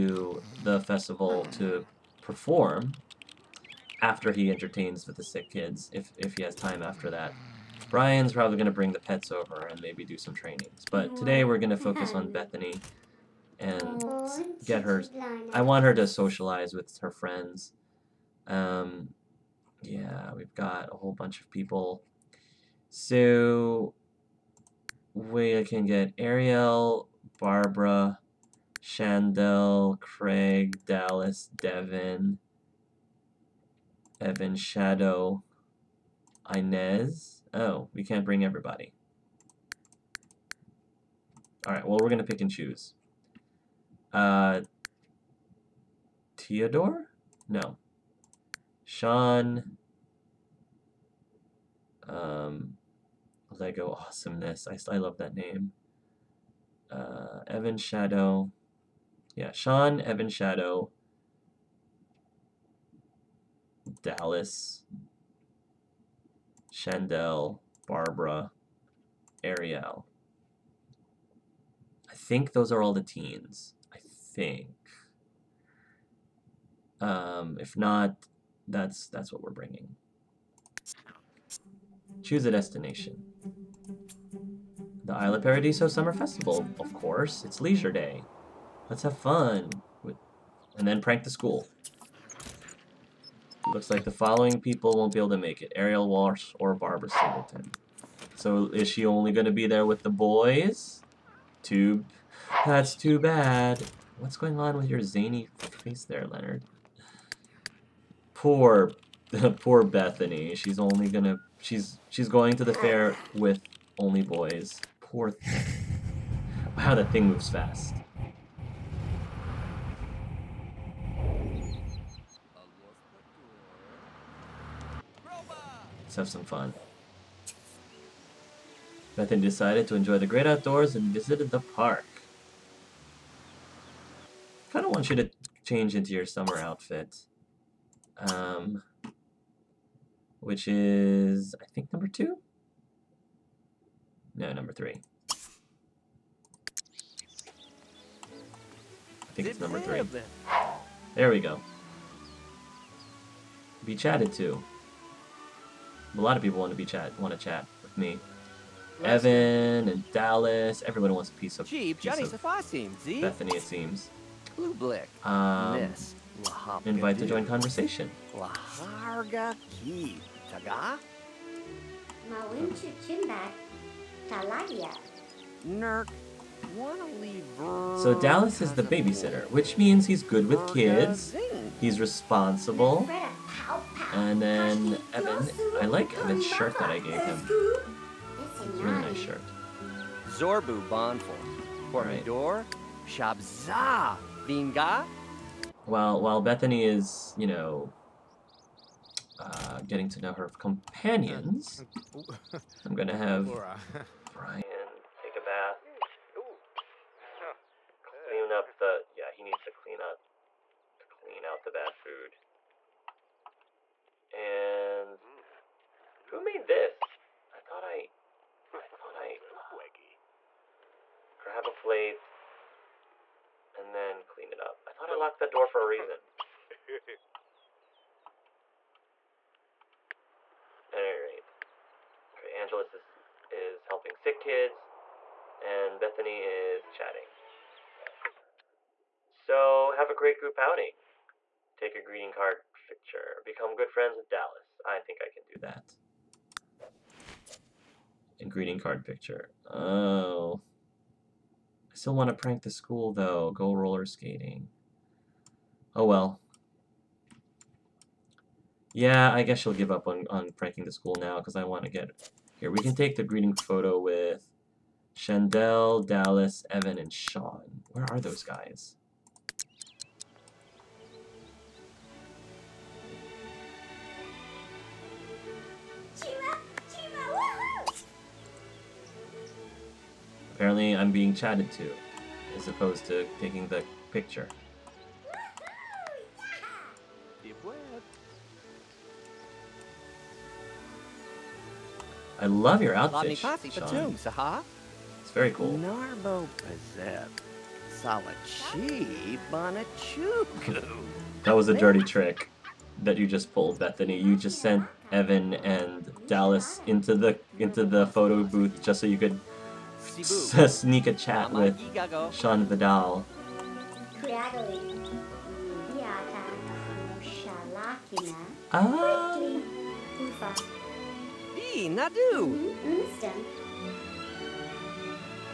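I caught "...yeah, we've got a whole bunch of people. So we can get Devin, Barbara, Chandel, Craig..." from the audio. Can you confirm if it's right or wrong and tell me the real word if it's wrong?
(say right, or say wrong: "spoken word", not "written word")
wrong: "Ariel", not "Devin".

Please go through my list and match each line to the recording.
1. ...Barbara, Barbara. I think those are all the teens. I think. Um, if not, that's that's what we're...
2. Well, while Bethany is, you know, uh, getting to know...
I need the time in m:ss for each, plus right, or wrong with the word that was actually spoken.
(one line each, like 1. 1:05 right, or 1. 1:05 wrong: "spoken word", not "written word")
1. 1:07 wrong: "Ariel", not "Barbara"
2. 3:15 right.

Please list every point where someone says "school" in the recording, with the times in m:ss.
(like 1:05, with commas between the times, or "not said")
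1:31, 4:12, 4:20.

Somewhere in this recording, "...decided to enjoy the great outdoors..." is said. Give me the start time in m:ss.
2:09.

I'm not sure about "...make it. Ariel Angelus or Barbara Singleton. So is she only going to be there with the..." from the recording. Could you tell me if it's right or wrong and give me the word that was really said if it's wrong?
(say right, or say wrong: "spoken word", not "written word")
wrong: "Walsh", not "Angelus".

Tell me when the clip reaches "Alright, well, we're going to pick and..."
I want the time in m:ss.
0:41.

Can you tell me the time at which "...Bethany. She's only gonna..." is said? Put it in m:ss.
1:49.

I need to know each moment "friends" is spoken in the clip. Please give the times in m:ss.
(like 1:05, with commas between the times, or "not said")
0:17, 4:03.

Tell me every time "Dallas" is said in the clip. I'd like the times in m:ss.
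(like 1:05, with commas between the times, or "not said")
0:30, 1:04, 2:40, 2:58, 4:04, 4:26, 5:06.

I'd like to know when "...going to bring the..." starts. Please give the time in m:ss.
0:08.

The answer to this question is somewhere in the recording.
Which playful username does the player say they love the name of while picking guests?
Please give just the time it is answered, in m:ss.
0:53.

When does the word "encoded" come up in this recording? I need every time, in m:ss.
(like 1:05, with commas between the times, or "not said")
not said.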